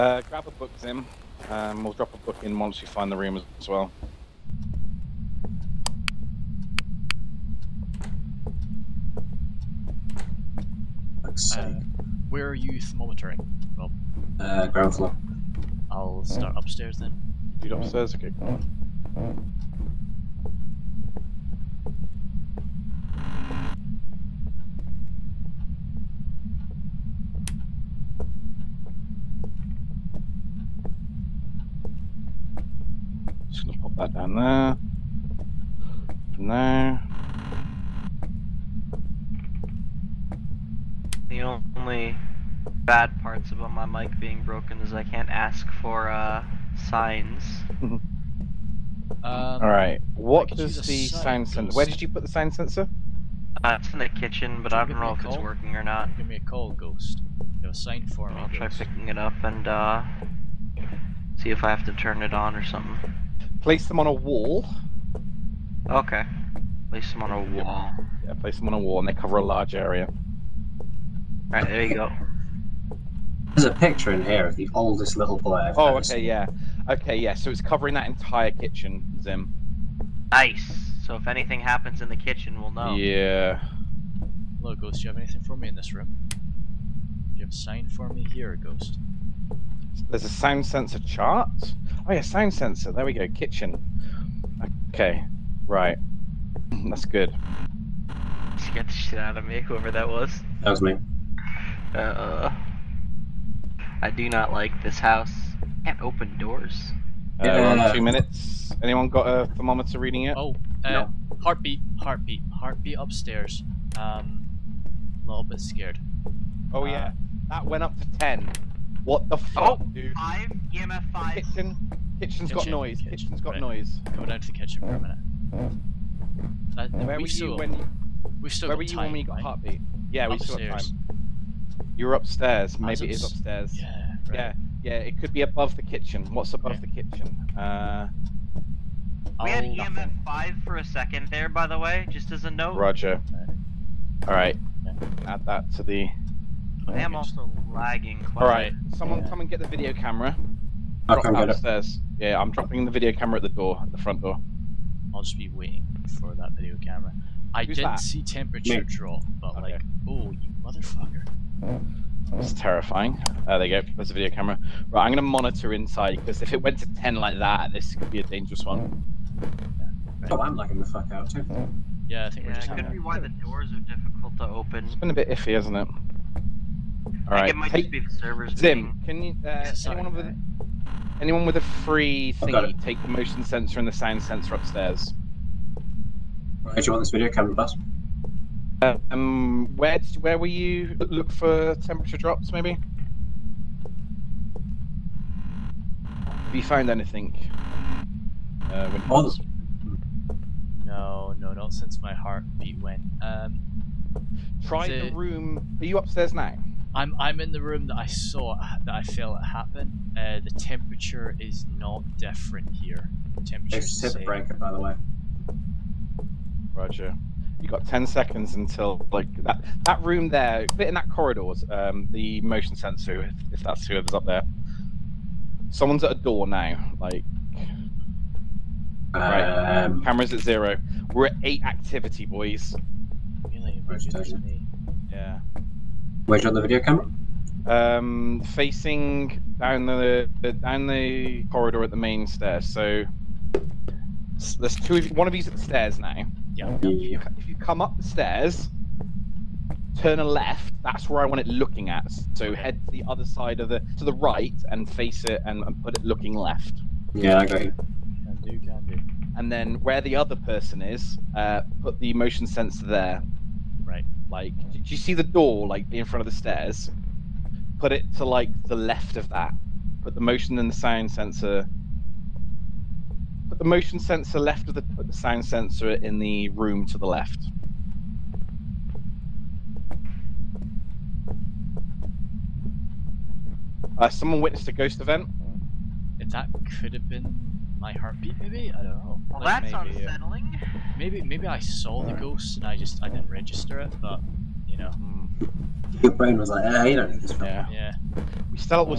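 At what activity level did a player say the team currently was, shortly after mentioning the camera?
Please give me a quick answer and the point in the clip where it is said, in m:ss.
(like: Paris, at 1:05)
8, at 3:51.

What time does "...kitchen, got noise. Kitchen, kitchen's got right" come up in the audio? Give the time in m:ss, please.
2:02.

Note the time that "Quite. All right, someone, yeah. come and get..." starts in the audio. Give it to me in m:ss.
2:28.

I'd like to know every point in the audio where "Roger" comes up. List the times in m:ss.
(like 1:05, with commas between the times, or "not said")
2:22, 3:36.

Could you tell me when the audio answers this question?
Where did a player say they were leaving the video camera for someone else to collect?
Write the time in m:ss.
2:33.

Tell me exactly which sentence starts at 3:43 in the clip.
If, if that's whoever's up there, someone's at a door now.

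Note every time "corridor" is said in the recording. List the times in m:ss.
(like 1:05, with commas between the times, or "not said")
3:41, 4:01.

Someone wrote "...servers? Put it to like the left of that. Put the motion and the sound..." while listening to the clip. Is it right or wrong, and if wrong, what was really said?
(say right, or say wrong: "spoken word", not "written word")
wrong: "stairs", not "servers".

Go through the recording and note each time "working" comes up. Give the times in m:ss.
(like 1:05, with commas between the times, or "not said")
0:55.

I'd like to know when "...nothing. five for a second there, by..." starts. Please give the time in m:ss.
2:19.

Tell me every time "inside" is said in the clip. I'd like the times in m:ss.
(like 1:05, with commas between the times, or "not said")
2:45.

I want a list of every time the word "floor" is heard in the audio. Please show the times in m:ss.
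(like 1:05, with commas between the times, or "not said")
0:14.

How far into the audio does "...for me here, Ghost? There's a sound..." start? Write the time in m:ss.
1:27.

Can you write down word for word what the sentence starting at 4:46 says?
that could have been my heartbeat maybe?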